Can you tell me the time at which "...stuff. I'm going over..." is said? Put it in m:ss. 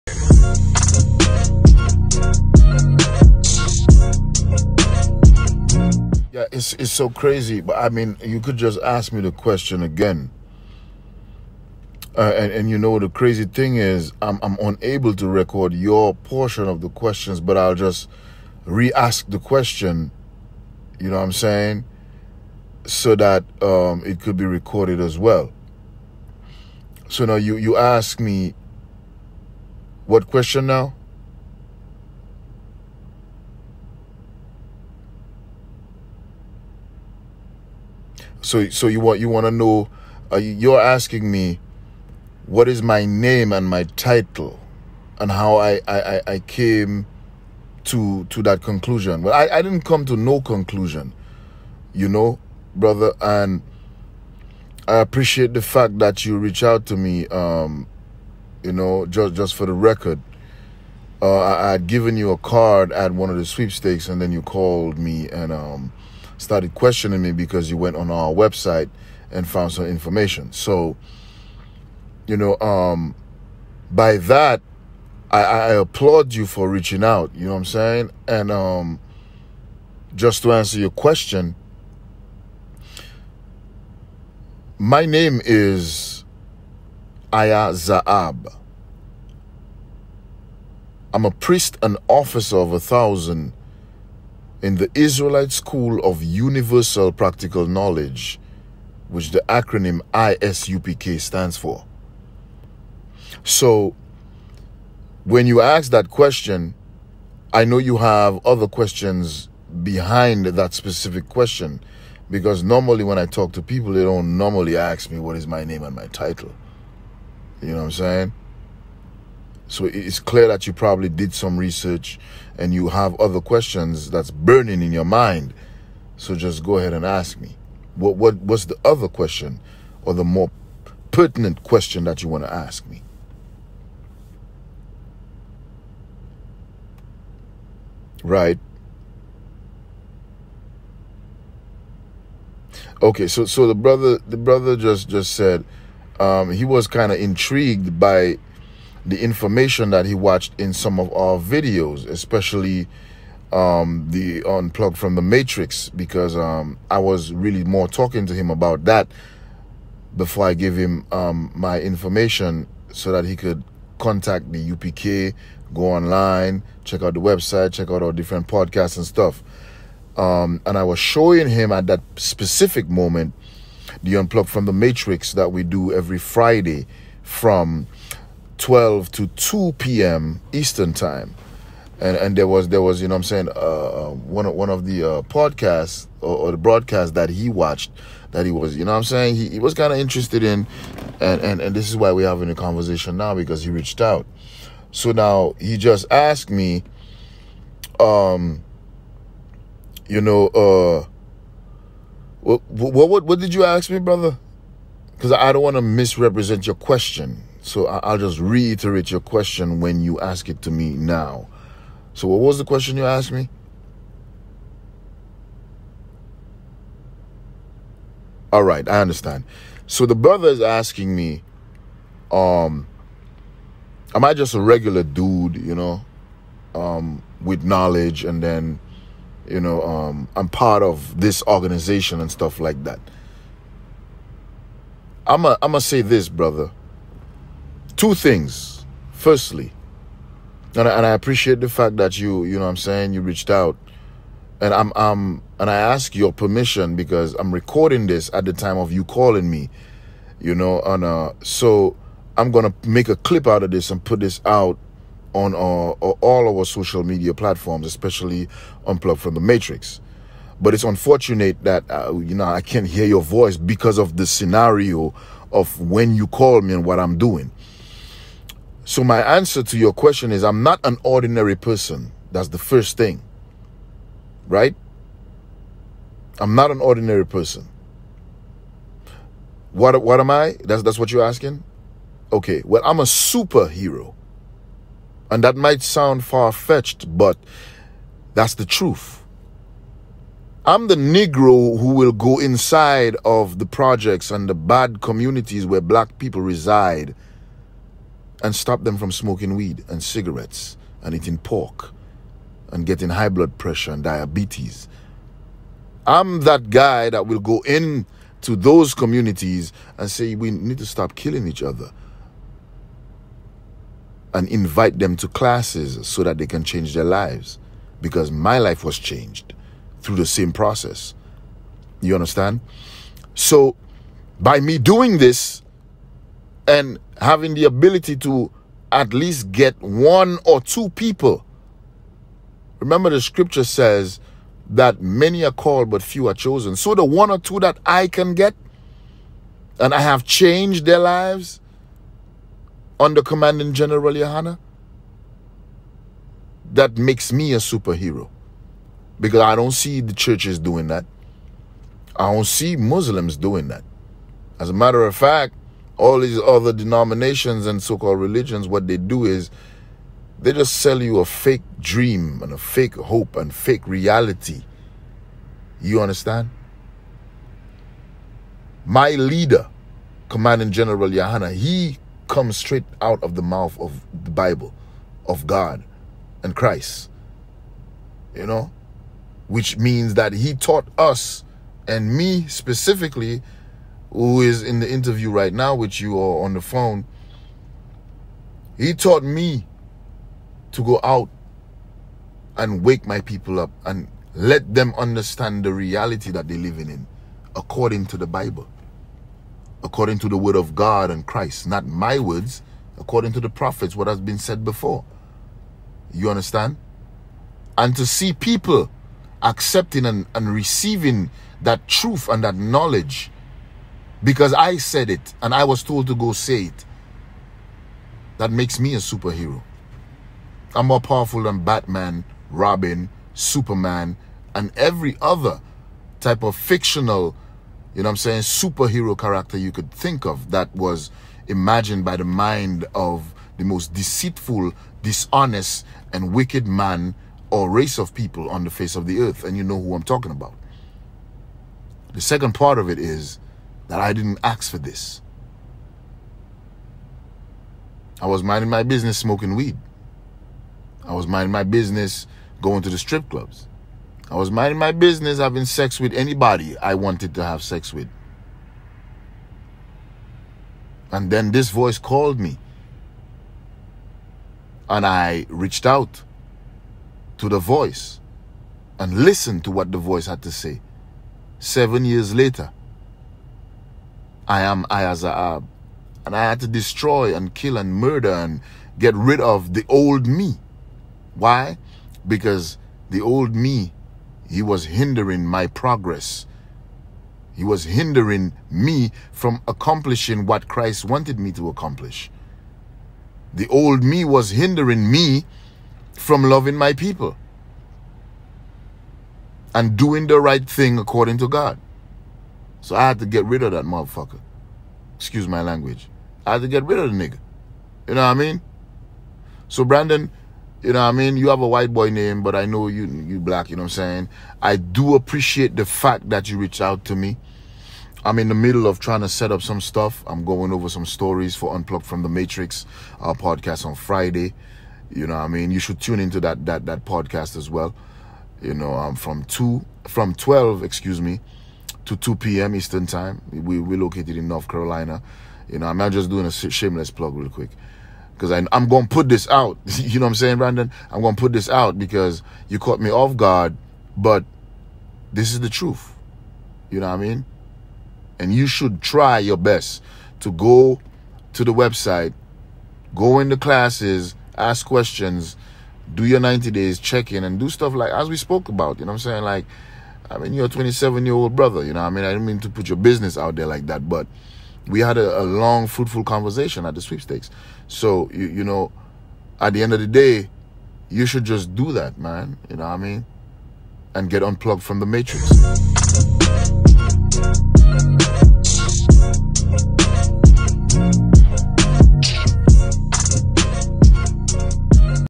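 8:39.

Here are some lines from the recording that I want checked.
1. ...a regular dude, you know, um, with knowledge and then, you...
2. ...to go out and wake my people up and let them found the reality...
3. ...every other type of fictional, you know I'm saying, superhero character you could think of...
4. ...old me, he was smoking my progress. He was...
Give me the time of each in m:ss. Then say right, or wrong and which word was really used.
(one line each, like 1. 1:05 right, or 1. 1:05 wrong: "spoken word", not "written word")
1. 3:44 right
2. 6:30 wrong: "understand", not "found"
3. 7:04 right
4. 8:03 wrong: "hindering", not "smoking".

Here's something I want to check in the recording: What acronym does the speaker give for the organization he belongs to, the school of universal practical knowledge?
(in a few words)
ISUPK.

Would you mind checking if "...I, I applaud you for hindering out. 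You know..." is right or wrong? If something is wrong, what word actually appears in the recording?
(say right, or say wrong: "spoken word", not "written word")
wrong: "reaching", not "hindering".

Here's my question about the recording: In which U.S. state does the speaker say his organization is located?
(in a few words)
North Carolina.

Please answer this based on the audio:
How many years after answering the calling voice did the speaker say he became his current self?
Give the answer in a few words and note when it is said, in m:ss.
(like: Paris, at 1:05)
7, at 7:51.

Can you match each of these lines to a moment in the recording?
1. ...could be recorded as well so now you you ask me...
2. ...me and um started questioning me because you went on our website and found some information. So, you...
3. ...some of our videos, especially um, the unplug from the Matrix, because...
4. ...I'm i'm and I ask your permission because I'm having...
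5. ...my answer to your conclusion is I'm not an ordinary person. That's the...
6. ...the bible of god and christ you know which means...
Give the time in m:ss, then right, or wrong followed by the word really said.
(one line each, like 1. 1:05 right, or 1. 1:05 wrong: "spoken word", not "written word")
1. 0:24 right
2. 1:04 right
3. 2:30 right
4. 4:04 wrong: "recording", not "having"
5. 4:29 wrong: "question", not "conclusion"
6. 6:14 right.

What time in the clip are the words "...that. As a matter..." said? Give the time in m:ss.
5:53.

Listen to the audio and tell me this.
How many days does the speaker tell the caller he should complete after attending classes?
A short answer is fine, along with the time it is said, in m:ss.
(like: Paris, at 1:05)
90, at 9:16.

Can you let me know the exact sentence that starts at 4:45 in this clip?
And that might sound far-fetched, but that's the truth.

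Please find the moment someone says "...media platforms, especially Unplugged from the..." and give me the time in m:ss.
4:17.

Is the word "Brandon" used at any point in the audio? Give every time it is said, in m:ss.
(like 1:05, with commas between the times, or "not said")
8:29, 9:00.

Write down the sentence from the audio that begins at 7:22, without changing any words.
The second part of it is that I didn't ask for this.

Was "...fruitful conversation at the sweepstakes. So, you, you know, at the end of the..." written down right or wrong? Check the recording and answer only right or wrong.
right.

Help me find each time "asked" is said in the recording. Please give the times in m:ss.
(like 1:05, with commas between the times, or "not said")
3:16, 3:33.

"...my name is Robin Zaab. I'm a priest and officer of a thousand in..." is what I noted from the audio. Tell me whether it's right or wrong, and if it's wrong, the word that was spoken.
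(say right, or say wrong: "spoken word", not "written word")
wrong: "Aya", not "Robin".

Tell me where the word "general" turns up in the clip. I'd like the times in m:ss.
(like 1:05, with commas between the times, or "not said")
5:43, 6:10.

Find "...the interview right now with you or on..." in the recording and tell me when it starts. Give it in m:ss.
6:24.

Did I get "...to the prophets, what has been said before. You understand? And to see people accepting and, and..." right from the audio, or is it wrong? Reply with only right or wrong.
right.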